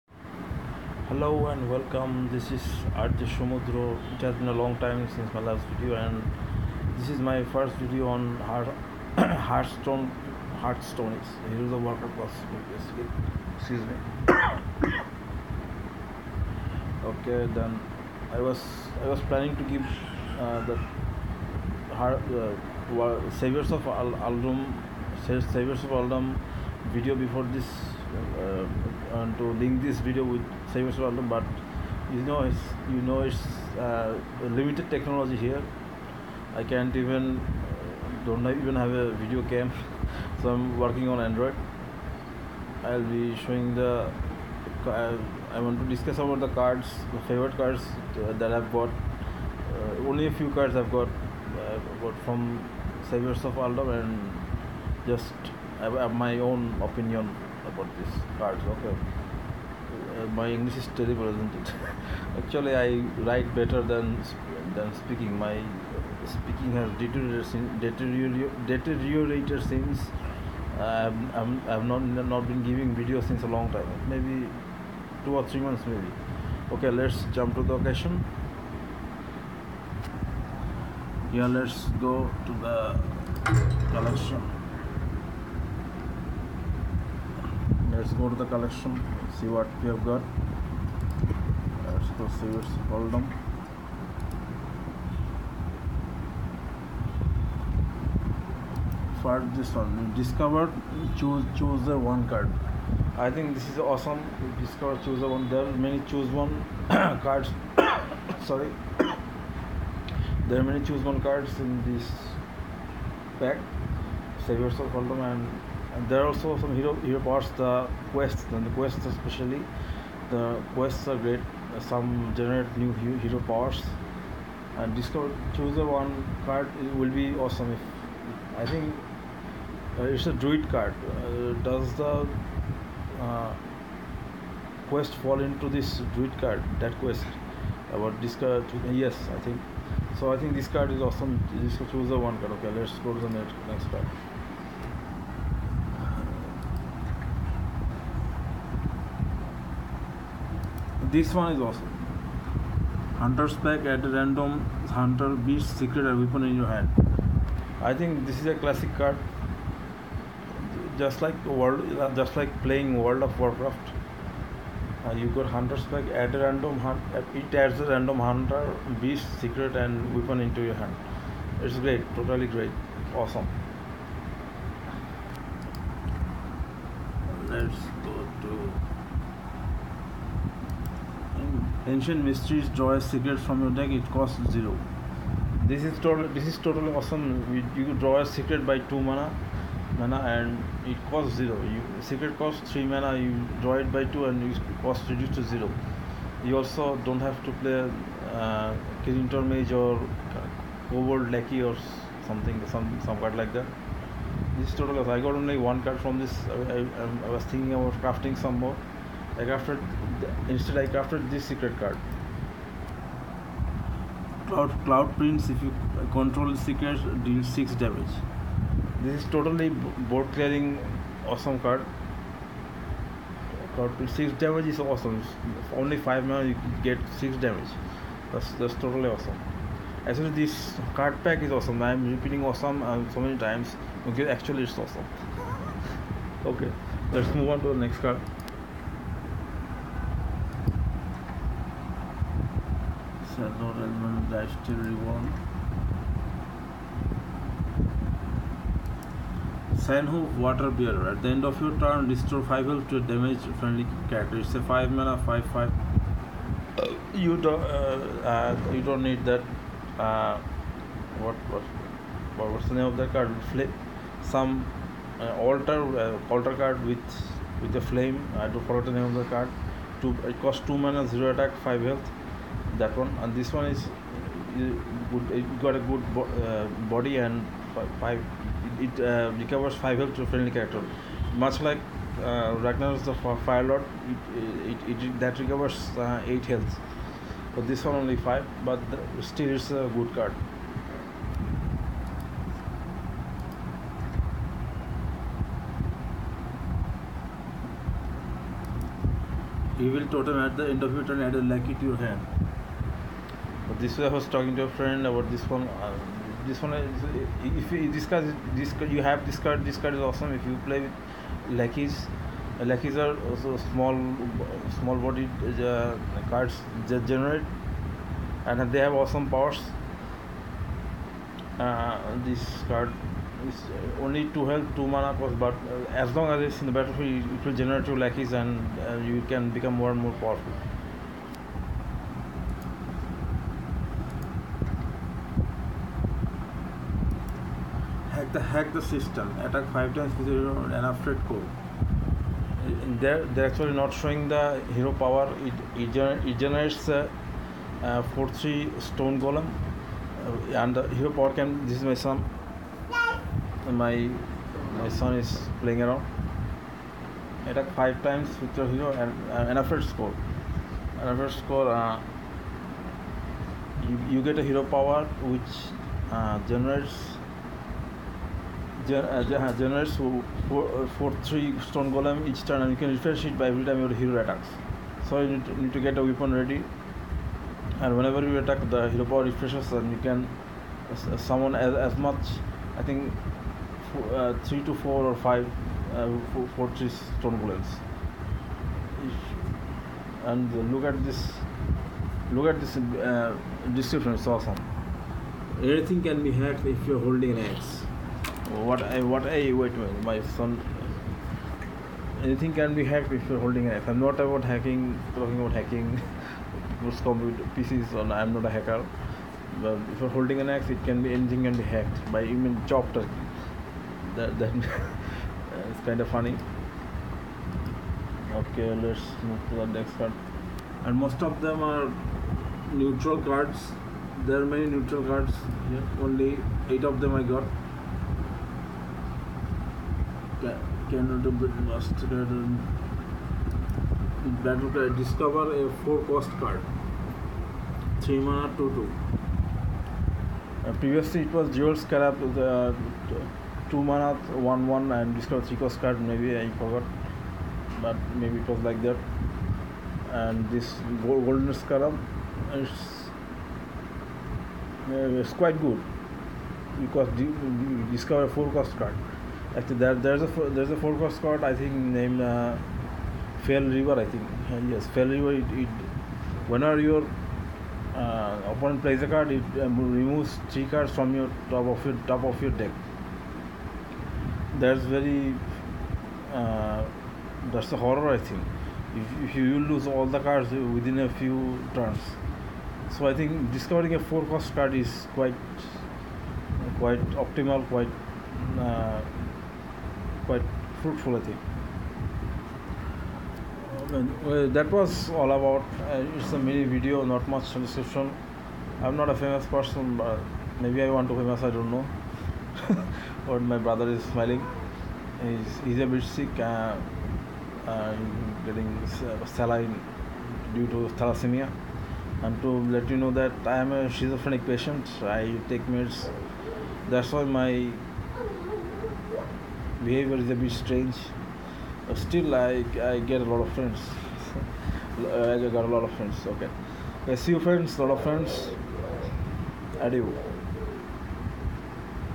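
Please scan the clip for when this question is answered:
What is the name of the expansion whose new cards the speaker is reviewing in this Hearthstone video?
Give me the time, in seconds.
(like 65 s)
25 s.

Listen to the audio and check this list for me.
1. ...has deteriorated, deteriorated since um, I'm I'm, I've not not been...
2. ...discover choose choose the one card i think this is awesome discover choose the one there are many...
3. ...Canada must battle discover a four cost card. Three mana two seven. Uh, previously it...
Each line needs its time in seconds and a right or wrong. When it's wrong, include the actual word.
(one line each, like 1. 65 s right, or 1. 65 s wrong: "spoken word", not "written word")
1. 66 s right
2. 100 s right
3. 430 s wrong: "two", not "seven".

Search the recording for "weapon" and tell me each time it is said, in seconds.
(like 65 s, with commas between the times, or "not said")
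156 s, 170 s, 376 s.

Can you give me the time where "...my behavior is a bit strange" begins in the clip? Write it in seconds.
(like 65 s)
517 s.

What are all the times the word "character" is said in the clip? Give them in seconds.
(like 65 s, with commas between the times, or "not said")
254 s, 280 s.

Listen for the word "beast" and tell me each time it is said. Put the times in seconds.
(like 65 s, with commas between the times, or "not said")
155 s, 169 s.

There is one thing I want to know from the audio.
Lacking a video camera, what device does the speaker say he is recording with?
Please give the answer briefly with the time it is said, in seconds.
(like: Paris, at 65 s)
Android, at 41 s.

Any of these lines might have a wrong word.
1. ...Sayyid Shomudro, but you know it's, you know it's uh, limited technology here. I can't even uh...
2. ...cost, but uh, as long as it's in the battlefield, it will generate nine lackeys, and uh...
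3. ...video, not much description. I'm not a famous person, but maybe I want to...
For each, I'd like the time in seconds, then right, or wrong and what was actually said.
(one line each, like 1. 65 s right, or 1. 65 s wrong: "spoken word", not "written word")
1. 30 s wrong: "Alum", not "Shomudro"
2. 325 s wrong: "two", not "nine"
3. 496 s right.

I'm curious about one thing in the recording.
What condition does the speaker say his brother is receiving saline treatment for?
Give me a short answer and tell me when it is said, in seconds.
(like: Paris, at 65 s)
thalassemia, at 510 s.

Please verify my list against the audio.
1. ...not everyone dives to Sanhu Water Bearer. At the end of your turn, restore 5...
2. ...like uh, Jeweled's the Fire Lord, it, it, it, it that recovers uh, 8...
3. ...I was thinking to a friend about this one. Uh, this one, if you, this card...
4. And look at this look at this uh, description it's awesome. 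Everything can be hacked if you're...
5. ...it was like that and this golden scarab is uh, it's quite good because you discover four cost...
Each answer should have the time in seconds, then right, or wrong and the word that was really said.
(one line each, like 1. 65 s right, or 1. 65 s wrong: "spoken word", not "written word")
1. 243 s right
2. 281 s wrong: "Ragnar", not "Jeweled"
3. 304 s wrong: "talking", not "thinking"
4. 390 s right
5. 448 s right.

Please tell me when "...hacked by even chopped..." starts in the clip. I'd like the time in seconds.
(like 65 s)
411 s.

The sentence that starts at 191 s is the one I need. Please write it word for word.
You secret costs three mana, you draw it by two and you cost reduced to zero.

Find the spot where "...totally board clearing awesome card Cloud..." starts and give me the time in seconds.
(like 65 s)
219 s.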